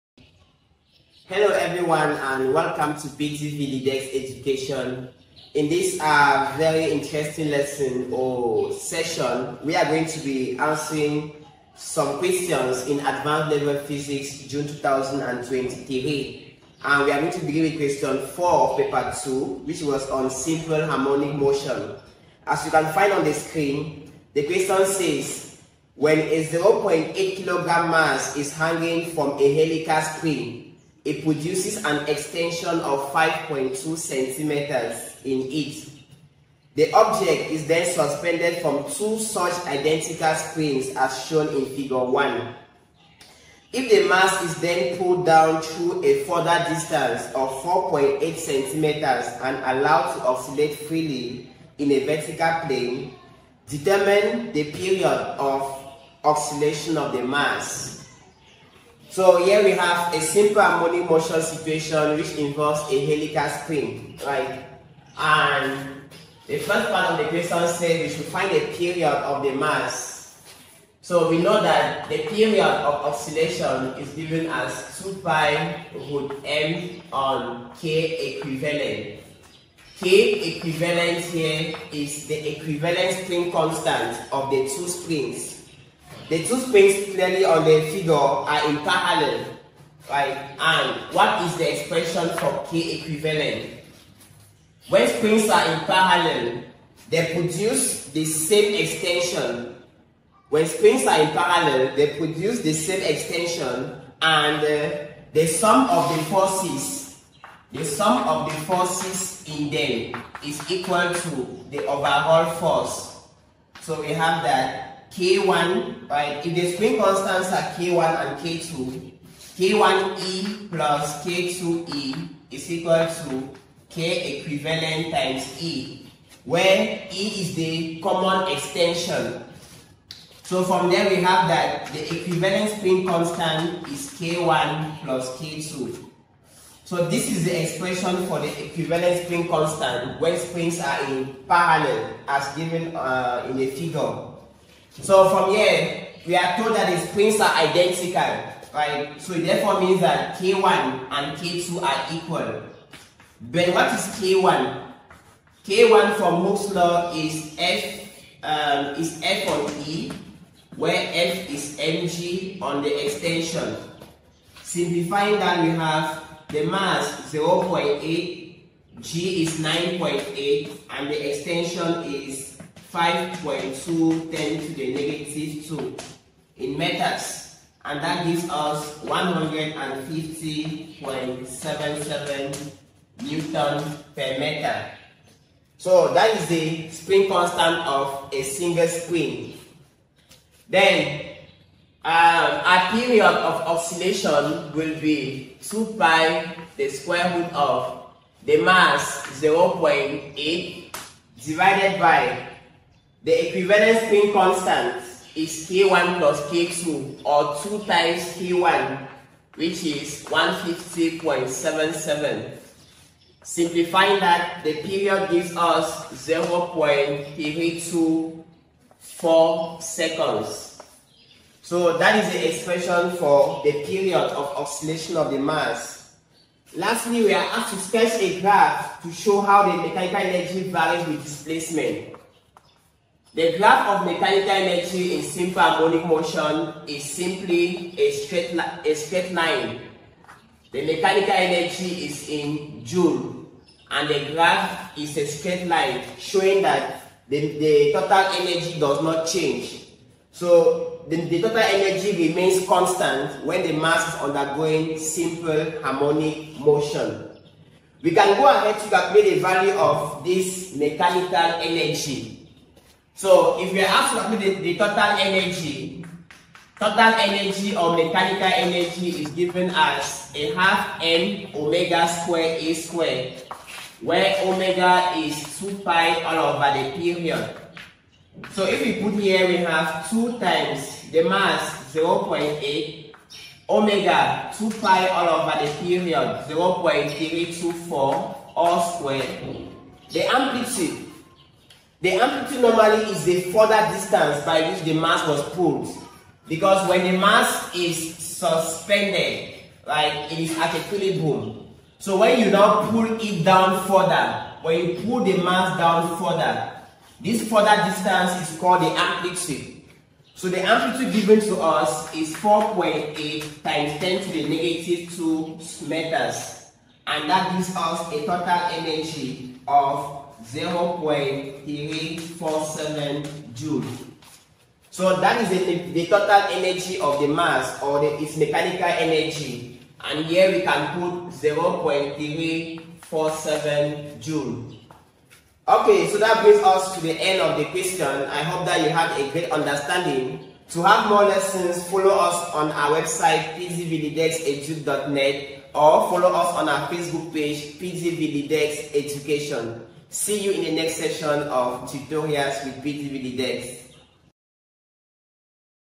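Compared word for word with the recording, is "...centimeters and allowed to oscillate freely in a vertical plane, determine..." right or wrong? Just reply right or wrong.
right.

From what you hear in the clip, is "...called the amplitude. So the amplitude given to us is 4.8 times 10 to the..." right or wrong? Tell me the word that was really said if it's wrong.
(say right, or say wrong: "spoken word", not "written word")
right.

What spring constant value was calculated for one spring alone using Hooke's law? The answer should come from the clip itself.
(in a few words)
150.77 N/m.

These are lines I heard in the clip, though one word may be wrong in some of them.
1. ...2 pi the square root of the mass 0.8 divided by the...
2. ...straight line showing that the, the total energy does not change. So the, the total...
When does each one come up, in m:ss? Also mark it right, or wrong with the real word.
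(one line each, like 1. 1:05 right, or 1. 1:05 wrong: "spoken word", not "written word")
1. 3:15 right
2. 4:05 right.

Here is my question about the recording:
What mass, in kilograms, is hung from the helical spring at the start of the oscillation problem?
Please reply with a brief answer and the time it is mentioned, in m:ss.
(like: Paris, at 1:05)
0.8 kg, at 0:26.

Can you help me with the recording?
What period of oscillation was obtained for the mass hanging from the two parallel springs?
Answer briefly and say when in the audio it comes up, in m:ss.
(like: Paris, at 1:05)
0.324 seconds, at 3:36.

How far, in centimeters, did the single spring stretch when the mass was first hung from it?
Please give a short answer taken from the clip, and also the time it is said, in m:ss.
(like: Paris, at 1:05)
5.2 centimeters, at 0:33.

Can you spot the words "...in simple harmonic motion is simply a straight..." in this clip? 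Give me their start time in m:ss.
3:55.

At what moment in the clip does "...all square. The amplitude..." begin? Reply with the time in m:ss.
4:48.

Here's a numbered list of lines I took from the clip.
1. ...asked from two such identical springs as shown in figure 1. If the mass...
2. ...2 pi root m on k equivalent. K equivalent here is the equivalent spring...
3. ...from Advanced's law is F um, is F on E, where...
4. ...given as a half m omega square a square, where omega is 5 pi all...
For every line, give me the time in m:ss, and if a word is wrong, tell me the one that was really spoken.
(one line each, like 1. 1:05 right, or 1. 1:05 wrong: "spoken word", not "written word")
1. 0:37 wrong: "suspended", not "asked"
2. 1:15 right
3. 2:36 wrong: "Hooke", not "Advanced"
4. 4:29 wrong: "2", not "5".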